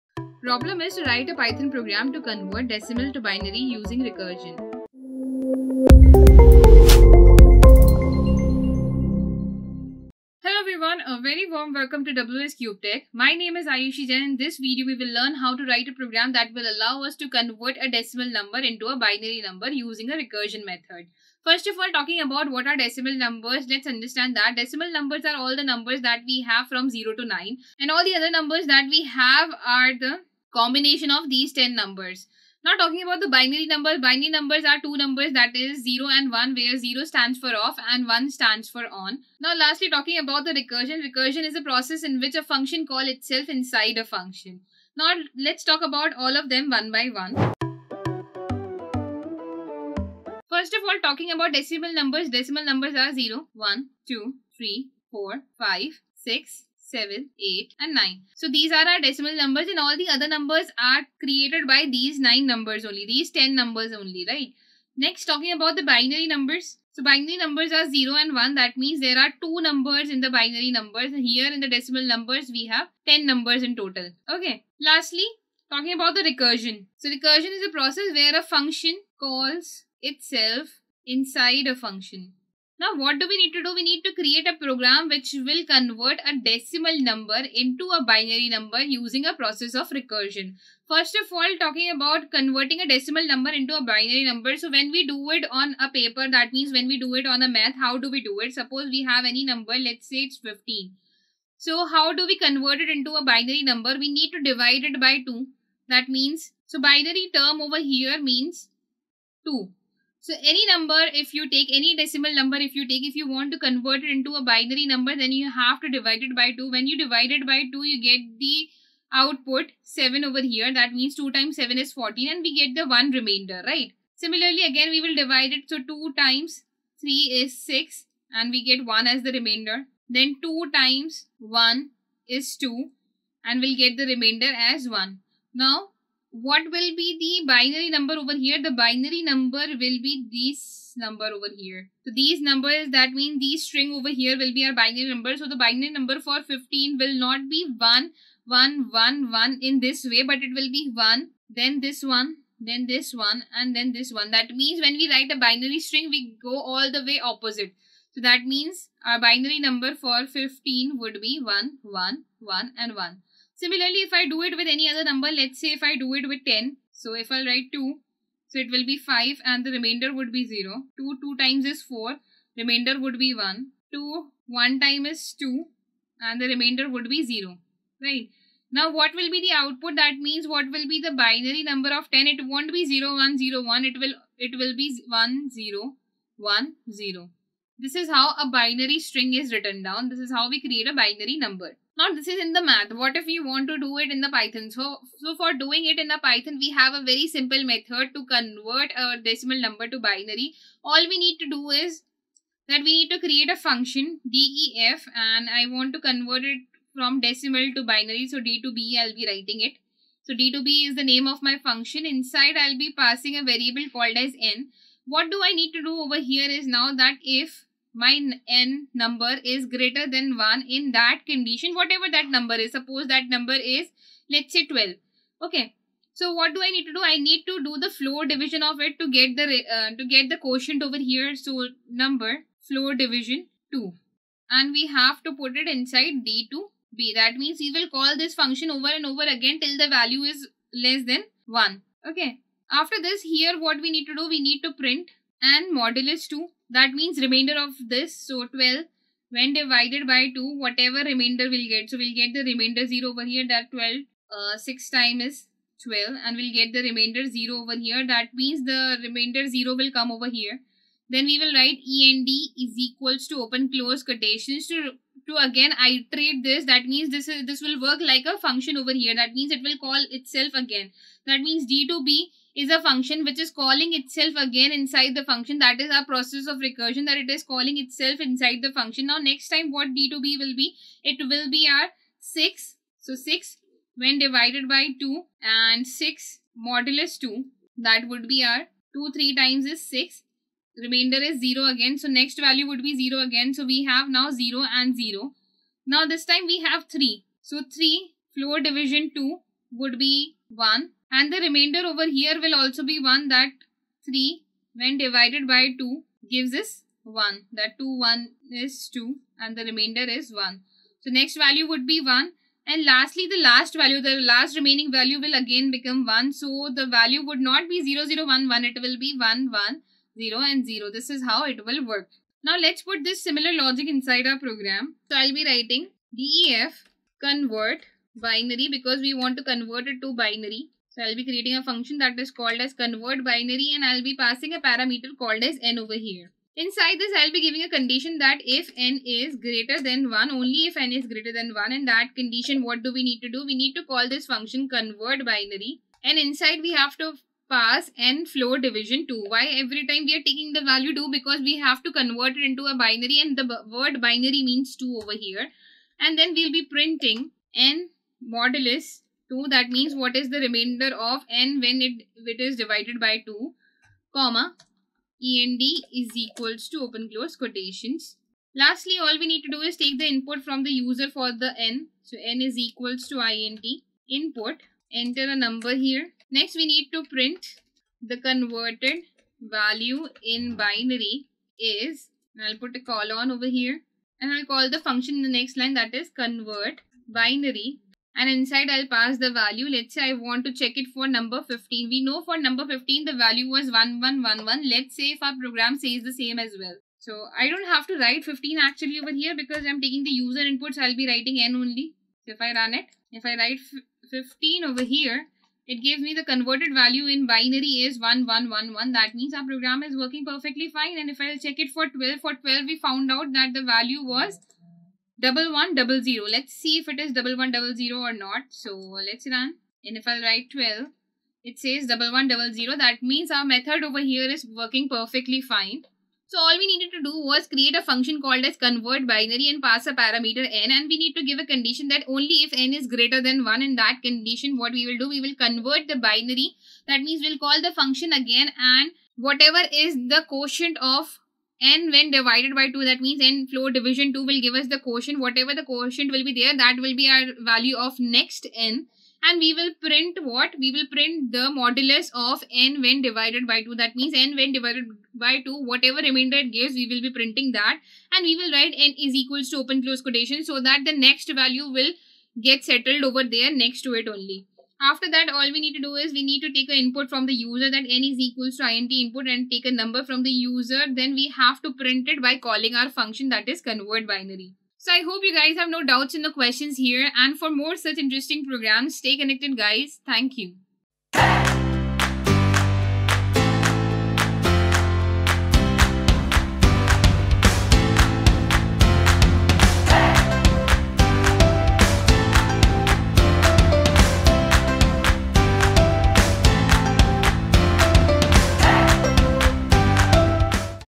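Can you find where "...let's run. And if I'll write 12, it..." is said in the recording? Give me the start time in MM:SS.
06:58.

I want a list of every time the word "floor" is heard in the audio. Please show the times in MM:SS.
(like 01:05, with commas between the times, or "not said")
03:47, 03:52, 04:58, 05:48, 07:23.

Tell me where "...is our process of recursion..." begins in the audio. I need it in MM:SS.
04:35.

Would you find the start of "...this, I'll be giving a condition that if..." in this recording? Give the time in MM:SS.
05:36.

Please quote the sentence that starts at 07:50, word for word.
Then we have to print it by calling our function that is convert binary.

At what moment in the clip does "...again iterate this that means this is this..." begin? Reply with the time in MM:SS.
04:25.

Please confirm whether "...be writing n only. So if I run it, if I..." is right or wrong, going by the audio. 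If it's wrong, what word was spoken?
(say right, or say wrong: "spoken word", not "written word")
right.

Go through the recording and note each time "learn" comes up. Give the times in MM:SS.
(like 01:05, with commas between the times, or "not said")
00:15.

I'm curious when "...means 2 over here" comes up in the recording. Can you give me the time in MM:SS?
05:54.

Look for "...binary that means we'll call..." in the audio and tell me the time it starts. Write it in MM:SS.
07:16.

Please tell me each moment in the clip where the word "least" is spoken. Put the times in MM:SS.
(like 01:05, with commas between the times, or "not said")
not said.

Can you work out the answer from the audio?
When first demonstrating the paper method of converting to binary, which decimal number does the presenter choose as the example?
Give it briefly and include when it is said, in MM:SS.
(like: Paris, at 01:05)
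15, at 01:39.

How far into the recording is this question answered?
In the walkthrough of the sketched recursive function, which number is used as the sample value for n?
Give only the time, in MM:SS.
03:44.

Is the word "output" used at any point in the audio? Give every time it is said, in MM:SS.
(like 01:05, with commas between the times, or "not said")
01:59, 02:59.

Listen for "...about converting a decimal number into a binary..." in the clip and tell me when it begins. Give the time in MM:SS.
01:31.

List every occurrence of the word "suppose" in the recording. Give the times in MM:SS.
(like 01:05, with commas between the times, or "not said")
01:38, 03:42.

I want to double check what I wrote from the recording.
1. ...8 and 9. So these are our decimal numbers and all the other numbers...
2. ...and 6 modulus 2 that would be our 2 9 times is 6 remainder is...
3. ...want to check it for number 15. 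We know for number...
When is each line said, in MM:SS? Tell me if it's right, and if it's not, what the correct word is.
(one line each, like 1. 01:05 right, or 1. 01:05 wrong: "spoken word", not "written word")
1. 00:57 right
2. 04:45 wrong: "3", not "9"
3. 06:30 right.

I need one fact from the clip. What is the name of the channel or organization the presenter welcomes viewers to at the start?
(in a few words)
WS Cube Tech.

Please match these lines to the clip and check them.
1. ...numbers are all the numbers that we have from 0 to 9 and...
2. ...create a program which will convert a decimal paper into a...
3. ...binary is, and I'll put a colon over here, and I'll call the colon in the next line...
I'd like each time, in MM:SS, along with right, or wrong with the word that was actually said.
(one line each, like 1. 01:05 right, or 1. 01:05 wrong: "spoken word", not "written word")
1. 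00:24 right
2. 01:24 wrong: "number", not "paper"
3. 06:20 wrong: "function", not "colon".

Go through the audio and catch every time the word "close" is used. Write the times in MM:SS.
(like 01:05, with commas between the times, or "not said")
04:23, 06:07, 07:39.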